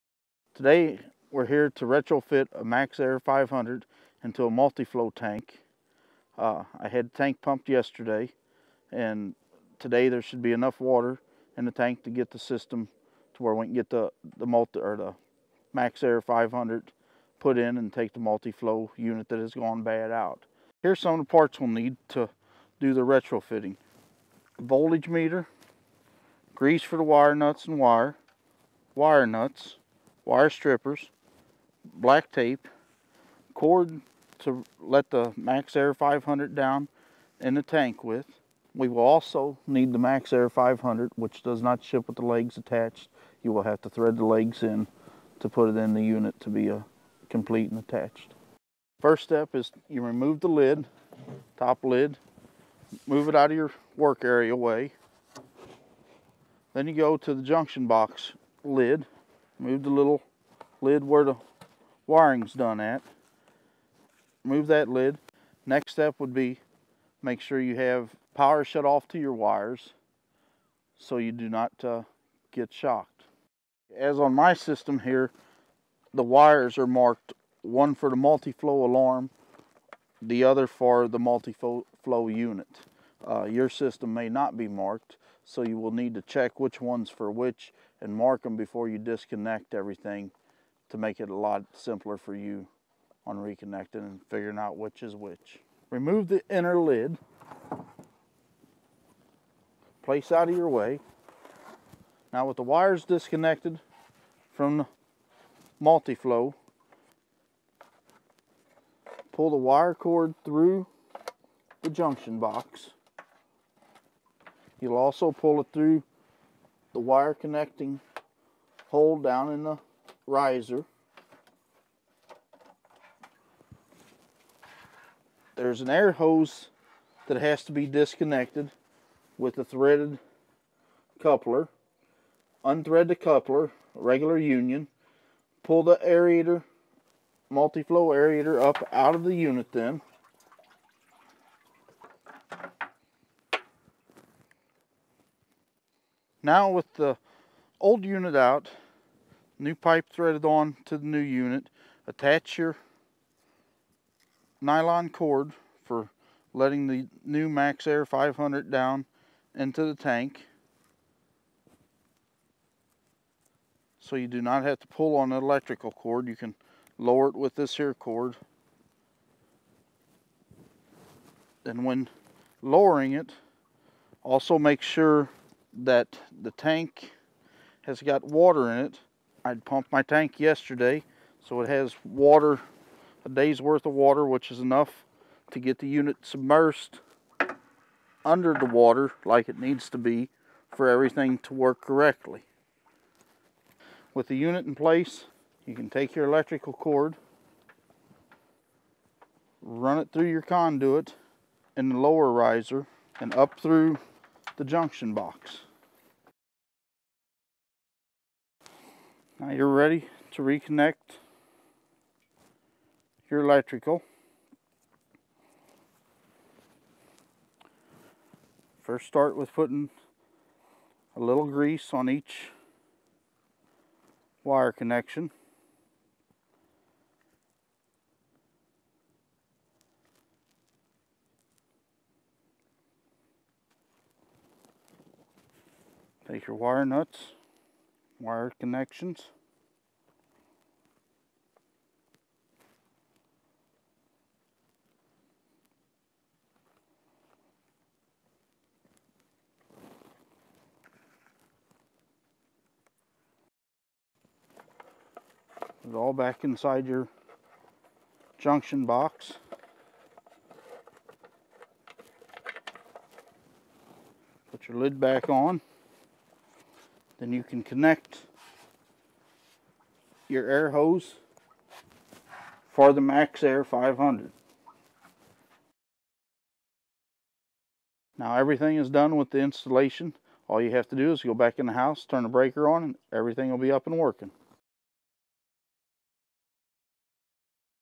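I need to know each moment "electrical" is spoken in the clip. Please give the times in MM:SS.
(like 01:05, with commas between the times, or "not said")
02:45, 03:16, 03:33.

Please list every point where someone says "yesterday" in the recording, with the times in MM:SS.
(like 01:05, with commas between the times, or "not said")
00:07, 03:00.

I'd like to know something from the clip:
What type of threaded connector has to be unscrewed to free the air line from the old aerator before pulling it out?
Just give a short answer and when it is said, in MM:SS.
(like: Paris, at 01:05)
regular union, at 02:13.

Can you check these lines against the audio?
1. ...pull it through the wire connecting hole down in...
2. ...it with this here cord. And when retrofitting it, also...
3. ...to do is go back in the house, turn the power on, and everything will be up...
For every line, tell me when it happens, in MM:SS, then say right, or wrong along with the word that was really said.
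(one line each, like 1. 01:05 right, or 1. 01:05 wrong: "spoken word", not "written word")
1. 01:55 right
2. 02:47 wrong: "lowering", not "retrofitting"
3. 04:40 wrong: "breaker", not "power".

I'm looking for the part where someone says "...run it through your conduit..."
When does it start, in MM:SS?
03:19.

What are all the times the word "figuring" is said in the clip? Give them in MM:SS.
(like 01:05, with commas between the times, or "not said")
01:34.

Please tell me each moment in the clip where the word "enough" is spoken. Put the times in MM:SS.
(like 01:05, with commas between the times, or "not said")
00:10, 03:04.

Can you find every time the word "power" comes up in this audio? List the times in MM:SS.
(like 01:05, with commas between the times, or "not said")
01:08.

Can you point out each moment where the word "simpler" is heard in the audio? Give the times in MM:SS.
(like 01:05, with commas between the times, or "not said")
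01:31.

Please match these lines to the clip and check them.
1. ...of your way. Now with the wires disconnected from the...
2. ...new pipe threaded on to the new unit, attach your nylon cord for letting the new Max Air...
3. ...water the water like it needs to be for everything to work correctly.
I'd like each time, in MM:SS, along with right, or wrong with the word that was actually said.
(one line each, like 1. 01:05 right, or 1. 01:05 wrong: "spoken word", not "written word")
1. 01:40 right
2. 02:29 right
3. 03:08 wrong: "under", not "water".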